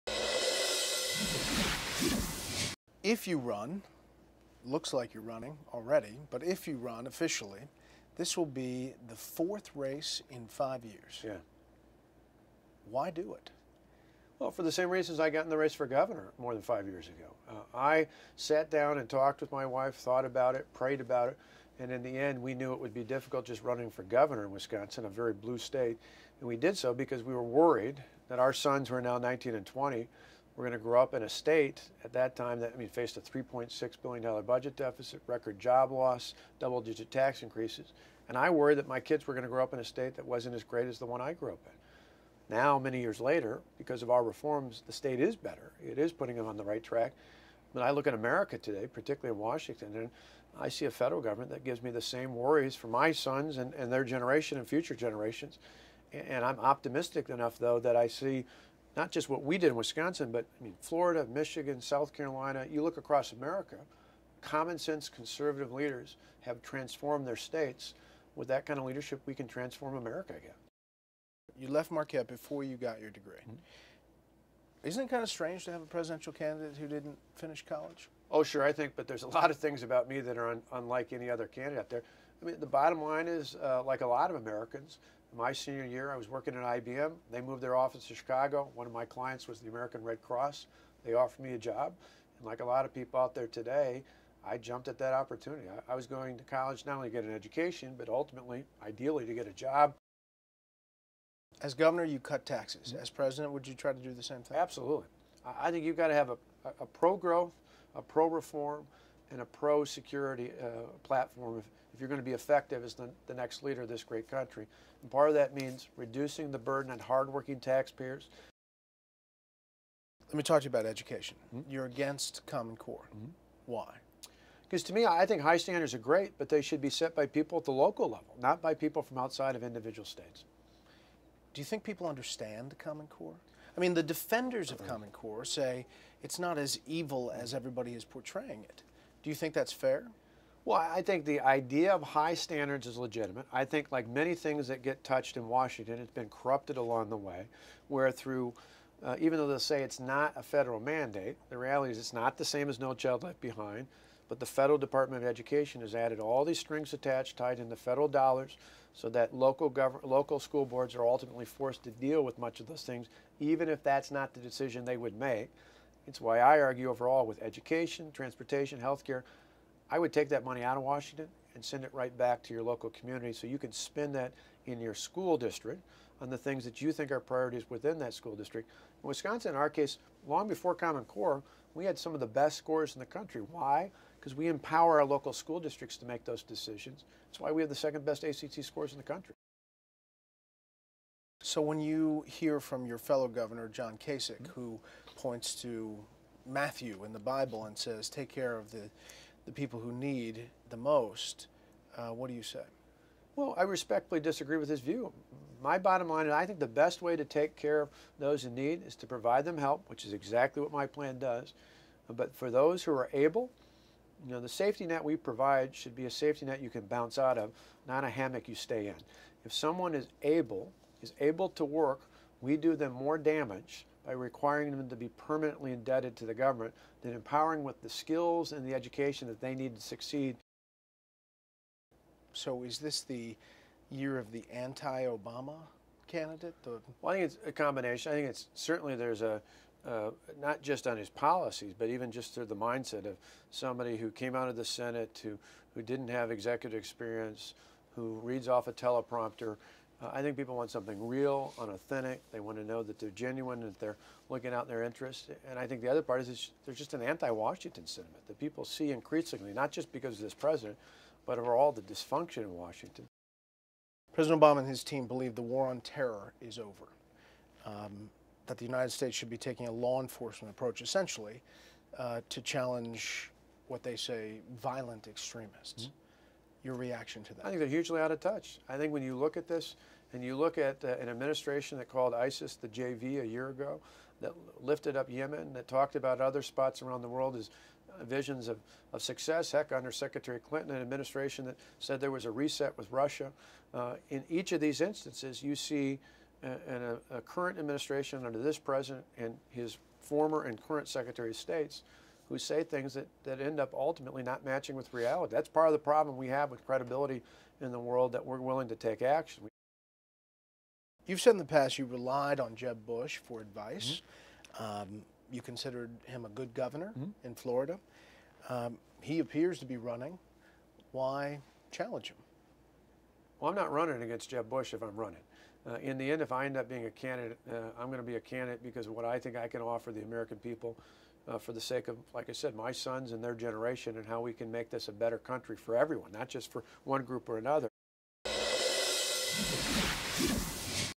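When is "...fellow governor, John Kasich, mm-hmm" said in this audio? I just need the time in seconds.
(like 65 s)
192 s.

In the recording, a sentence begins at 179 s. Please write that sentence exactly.
In Wisconsin, in our case, long before Common Core, we had some of the best scores in the country.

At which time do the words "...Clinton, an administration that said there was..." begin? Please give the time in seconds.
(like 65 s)
290 s.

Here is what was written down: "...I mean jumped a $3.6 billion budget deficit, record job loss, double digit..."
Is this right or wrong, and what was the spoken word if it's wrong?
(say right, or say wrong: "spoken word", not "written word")
wrong: "faced", not "jumped".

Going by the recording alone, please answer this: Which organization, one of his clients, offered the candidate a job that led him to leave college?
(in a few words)
American Red Cross.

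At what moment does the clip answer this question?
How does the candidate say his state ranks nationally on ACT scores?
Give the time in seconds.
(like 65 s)
187 s.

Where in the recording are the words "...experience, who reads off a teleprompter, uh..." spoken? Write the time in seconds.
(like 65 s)
246 s.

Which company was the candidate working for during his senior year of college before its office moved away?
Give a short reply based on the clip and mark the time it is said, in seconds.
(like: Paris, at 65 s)
IBM, at 86 s.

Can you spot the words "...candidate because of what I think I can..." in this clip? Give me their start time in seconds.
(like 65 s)
328 s.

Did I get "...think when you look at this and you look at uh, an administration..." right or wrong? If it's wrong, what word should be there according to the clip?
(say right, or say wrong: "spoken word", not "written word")
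right.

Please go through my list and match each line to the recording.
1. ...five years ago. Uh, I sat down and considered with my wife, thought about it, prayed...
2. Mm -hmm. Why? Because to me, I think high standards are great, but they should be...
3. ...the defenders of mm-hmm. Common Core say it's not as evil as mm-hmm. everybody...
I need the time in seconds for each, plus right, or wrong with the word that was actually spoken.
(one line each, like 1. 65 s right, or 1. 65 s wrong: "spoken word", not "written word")
1. 16 s wrong: "talked", not "considered"
2. 123 s right
3. 133 s right.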